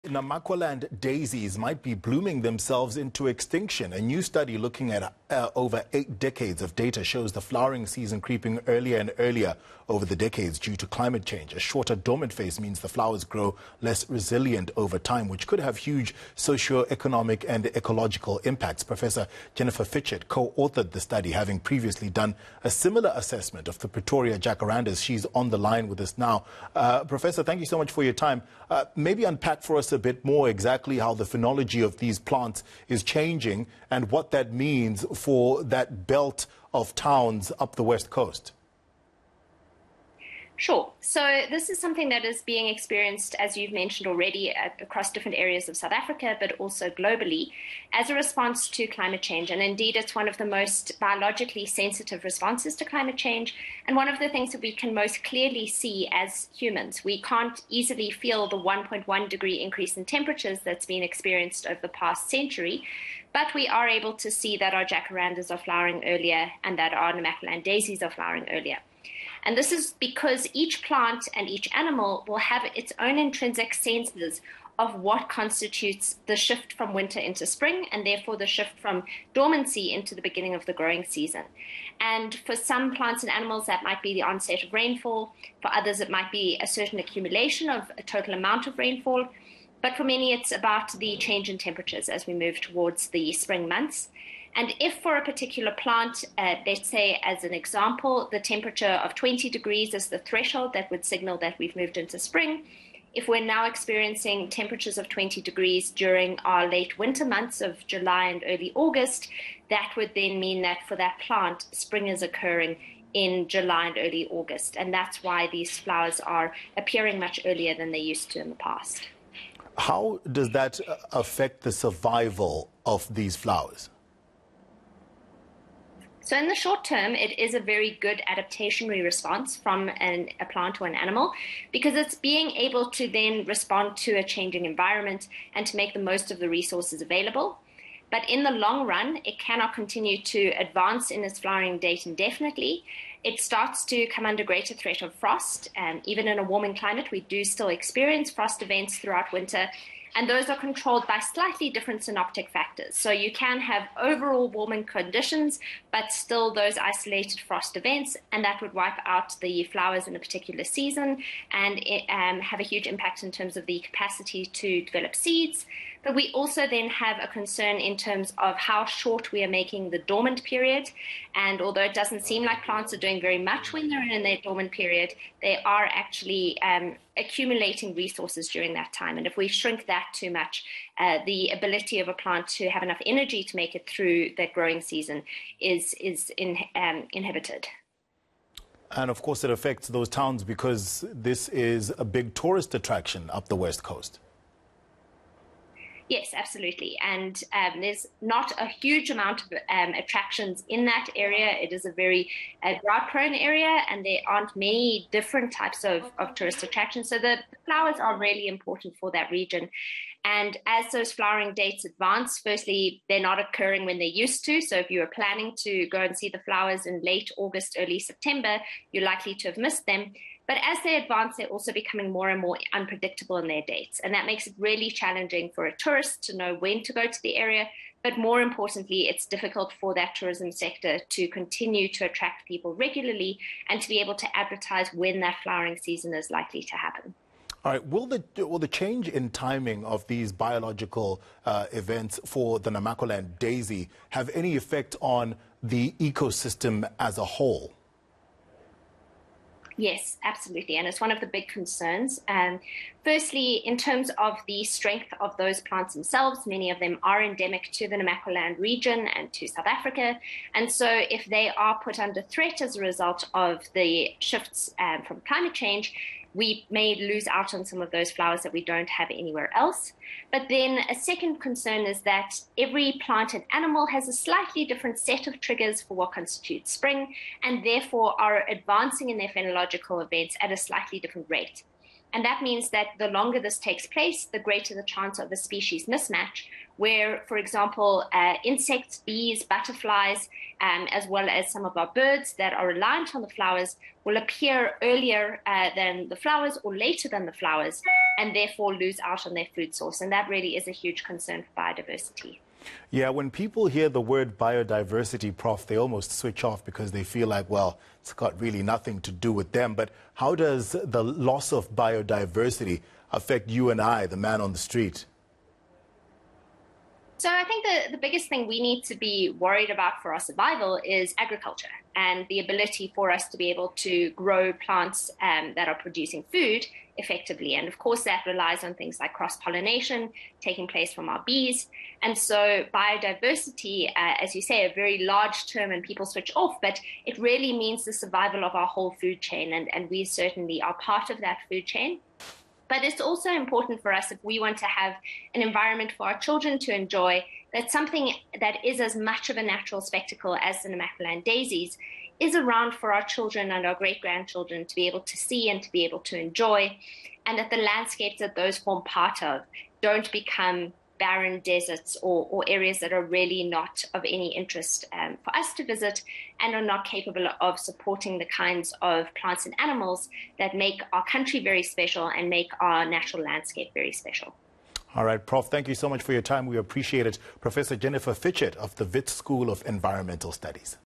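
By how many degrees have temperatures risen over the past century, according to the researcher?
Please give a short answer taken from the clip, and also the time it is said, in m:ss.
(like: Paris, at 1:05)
1.1 degrees, at 0:58.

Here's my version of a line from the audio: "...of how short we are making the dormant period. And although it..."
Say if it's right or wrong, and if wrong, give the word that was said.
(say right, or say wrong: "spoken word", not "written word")
right.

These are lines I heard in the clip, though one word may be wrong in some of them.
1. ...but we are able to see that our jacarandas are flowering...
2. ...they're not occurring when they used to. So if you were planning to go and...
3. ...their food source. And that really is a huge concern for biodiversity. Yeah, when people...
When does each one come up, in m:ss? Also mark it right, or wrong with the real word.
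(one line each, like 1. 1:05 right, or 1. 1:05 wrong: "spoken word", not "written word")
1. 1:03 right
2. 3:33 right
3. 4:59 right.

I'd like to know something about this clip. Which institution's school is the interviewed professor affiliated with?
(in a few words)
Wits School of Environmental Studies.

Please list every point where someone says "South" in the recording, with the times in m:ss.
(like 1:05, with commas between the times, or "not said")
0:45, 4:19.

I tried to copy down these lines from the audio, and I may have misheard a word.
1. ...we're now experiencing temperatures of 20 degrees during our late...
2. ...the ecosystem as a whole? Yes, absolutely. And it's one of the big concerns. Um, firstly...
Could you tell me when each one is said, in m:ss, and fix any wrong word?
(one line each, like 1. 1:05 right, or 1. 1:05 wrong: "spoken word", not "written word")
1. 1:43 right
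2. 4:05 right.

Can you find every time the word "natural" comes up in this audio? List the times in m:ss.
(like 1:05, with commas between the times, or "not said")
5:49, 6:12.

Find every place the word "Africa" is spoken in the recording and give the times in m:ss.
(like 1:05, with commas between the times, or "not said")
0:45, 4:19.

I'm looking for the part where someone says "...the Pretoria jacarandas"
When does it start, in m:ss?
0:23.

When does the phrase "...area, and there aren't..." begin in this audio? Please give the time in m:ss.
3:23.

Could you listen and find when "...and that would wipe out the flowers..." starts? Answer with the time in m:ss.
2:38.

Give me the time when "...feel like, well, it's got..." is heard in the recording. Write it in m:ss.
5:07.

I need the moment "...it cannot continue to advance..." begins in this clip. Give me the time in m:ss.
2:19.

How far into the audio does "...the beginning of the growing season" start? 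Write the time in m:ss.
1:20.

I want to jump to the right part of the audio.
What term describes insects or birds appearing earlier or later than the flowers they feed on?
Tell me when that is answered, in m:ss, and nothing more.
4:45.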